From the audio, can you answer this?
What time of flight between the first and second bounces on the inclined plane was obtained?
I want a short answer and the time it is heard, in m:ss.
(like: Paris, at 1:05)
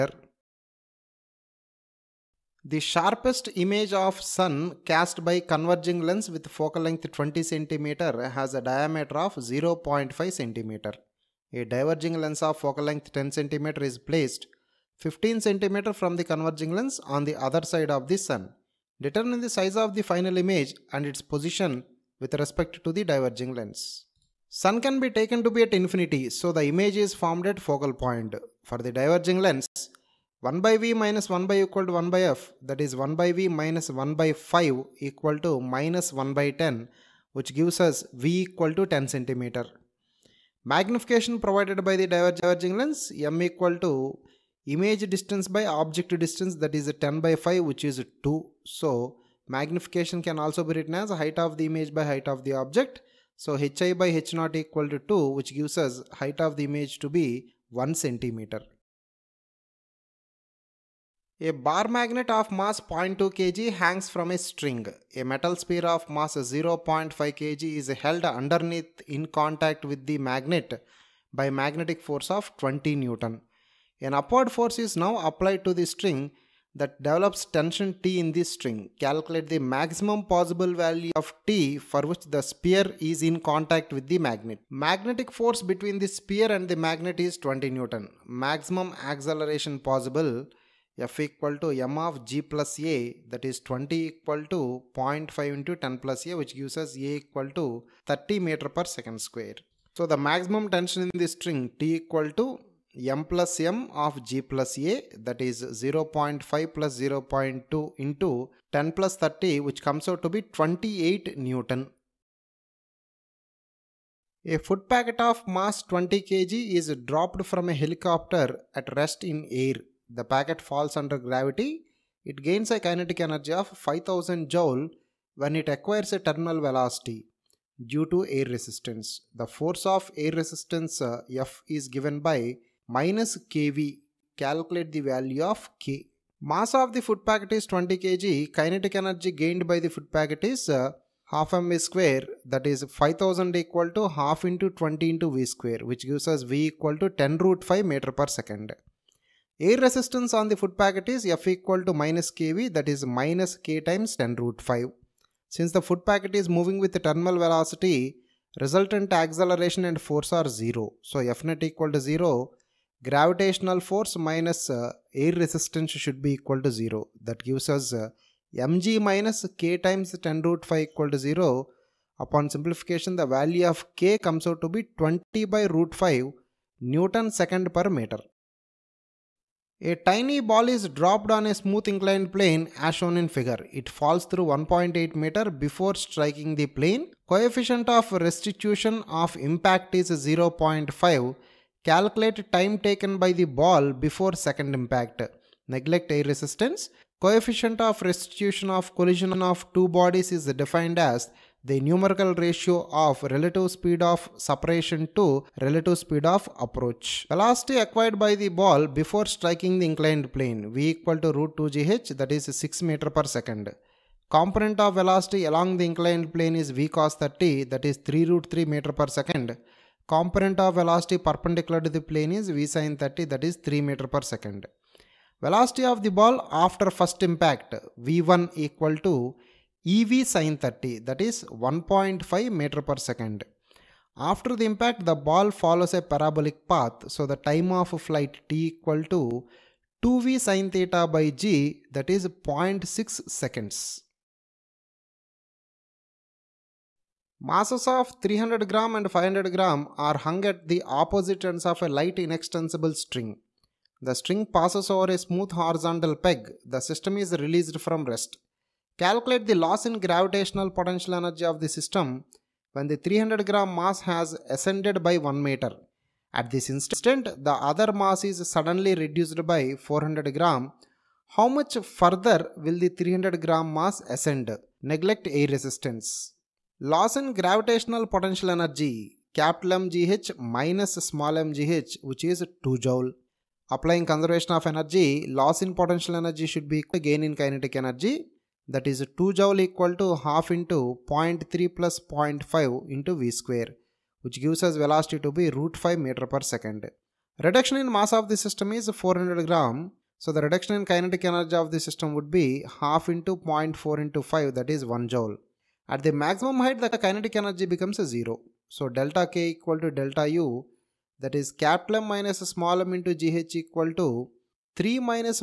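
0.6 seconds, at 4:02.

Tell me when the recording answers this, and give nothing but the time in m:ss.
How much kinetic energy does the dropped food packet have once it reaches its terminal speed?
2:03.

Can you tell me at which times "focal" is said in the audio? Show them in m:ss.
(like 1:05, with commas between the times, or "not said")
0:06, 0:12, 0:27.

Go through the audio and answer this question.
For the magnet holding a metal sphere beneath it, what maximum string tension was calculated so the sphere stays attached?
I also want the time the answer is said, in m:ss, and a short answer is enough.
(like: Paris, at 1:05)
28 newton, at 1:50.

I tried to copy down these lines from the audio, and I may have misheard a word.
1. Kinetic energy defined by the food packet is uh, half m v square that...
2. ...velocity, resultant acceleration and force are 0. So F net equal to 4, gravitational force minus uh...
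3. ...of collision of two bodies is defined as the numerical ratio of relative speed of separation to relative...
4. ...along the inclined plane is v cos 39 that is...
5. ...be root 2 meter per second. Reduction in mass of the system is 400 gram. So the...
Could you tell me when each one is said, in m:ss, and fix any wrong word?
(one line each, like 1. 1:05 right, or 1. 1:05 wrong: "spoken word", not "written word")
1. 2:18 wrong: "gained", not "defined"
2. 2:37 wrong: "0", not "4"
3. 3:18 right
4. 3:35 wrong: "30", not "39"
5. 4:55 wrong: "5", not "2".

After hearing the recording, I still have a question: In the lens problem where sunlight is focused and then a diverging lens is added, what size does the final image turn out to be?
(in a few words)
1 cm.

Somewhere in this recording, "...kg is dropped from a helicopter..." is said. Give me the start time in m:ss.
1:56.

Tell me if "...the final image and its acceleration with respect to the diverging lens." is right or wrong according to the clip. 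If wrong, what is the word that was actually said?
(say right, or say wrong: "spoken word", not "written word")
wrong: "position", not "acceleration".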